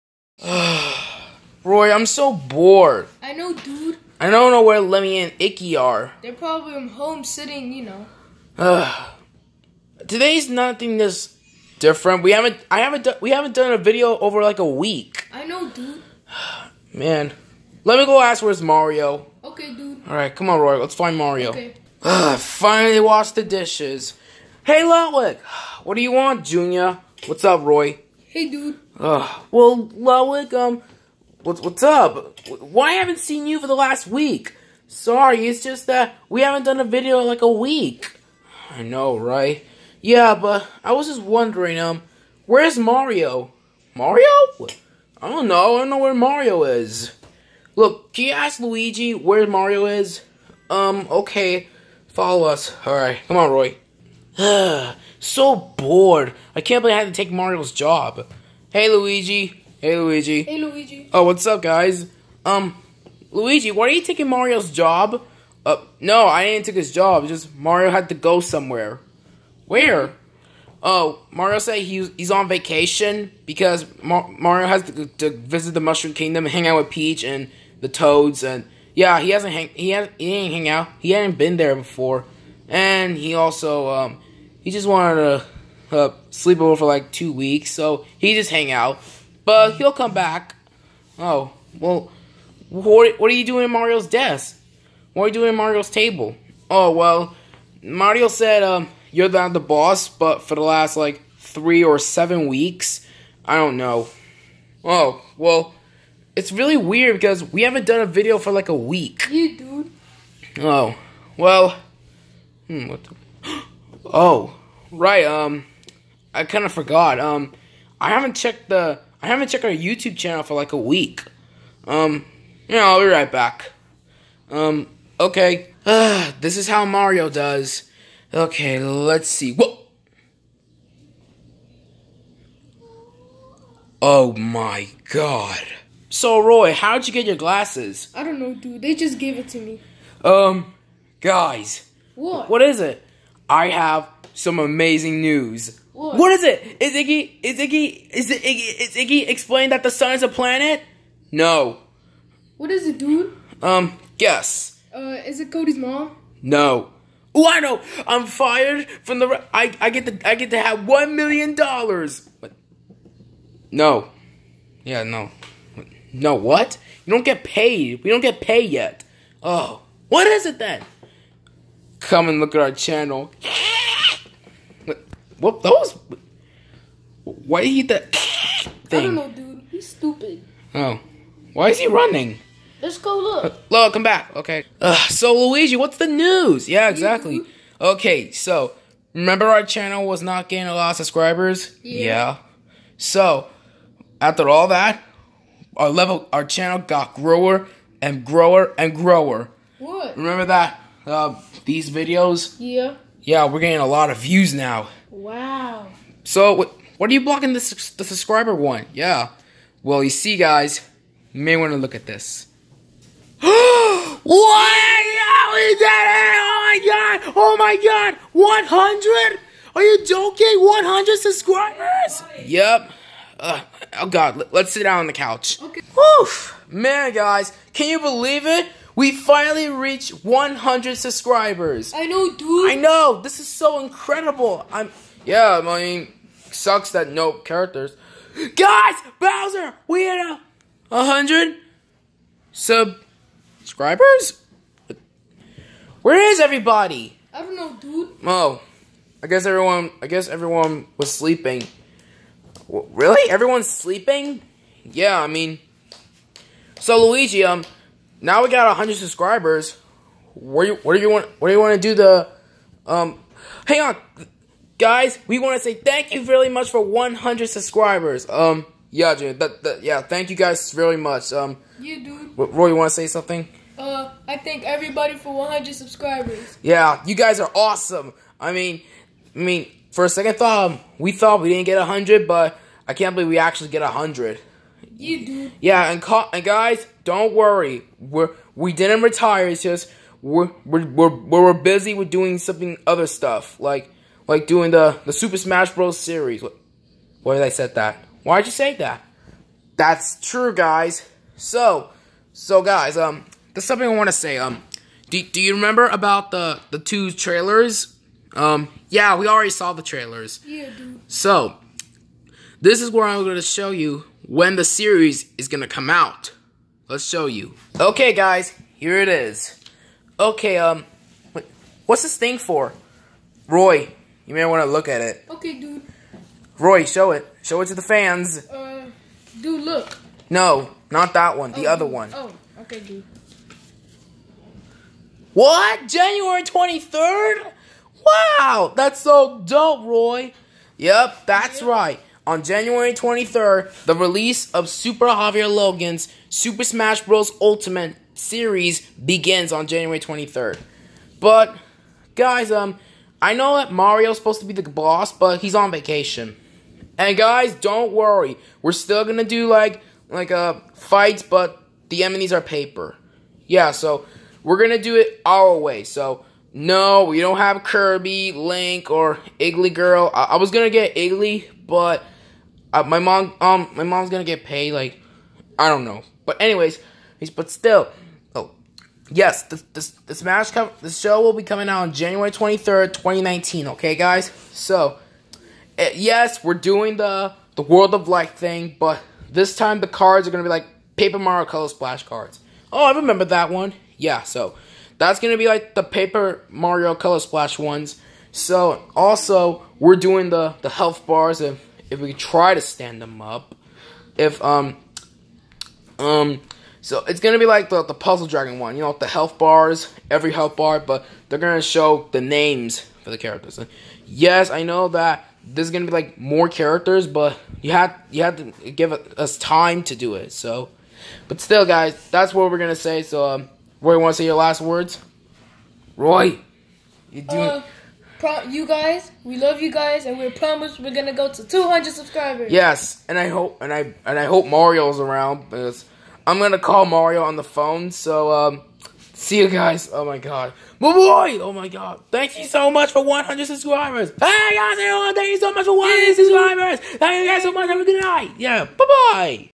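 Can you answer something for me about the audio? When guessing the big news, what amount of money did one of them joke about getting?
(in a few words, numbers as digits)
1 million dollars.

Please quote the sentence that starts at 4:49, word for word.
It's just we're, we're, we're, we're busy with doing something other stuff.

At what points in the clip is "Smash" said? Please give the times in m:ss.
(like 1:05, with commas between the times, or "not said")
4:55, 5:46, 6:20.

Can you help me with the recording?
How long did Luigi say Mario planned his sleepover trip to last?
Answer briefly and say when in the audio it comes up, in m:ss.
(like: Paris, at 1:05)
2 weeks, at 1:27.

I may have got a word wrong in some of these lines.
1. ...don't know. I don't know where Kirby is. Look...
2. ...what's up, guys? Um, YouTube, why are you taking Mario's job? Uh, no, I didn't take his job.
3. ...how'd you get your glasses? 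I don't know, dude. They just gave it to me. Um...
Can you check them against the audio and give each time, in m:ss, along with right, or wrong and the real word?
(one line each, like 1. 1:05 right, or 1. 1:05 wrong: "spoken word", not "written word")
1. 0:45 wrong: "Mario", not "Kirby"
2. 1:01 wrong: "Luigi", not "YouTube"
3. 2:16 right.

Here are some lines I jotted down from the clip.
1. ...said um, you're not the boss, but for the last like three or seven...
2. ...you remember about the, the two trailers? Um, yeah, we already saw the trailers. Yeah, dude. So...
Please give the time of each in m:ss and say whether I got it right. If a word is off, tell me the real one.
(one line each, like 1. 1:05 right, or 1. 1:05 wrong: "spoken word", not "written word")
1. 1:38 right
2. 5:05 right.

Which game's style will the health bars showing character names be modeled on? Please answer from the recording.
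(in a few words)
Puzzle Dragon.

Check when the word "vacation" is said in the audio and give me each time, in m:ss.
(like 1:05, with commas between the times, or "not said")
1:12, 5:55.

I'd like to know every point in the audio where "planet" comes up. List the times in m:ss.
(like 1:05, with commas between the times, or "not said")
2:30.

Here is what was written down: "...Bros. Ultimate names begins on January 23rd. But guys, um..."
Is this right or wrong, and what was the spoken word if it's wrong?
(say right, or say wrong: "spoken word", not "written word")
wrong: "series", not "names".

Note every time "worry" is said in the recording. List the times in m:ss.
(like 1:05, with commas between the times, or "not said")
4:47, 5:57.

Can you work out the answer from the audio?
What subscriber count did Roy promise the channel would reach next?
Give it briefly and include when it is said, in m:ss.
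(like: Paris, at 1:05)
200, at 7:11.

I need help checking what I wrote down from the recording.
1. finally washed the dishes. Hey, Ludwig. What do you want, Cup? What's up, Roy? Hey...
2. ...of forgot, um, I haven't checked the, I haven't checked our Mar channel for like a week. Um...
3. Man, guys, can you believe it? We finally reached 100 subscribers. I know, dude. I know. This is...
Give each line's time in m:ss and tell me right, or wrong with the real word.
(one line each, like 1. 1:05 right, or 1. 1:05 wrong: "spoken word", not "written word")
1. 0:22 wrong: "Junior", not "Cup"
2. 1:56 wrong: "YouTube", not "Mar"
3. 3:46 right.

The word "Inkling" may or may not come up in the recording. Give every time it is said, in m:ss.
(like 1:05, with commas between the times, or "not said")
6:09.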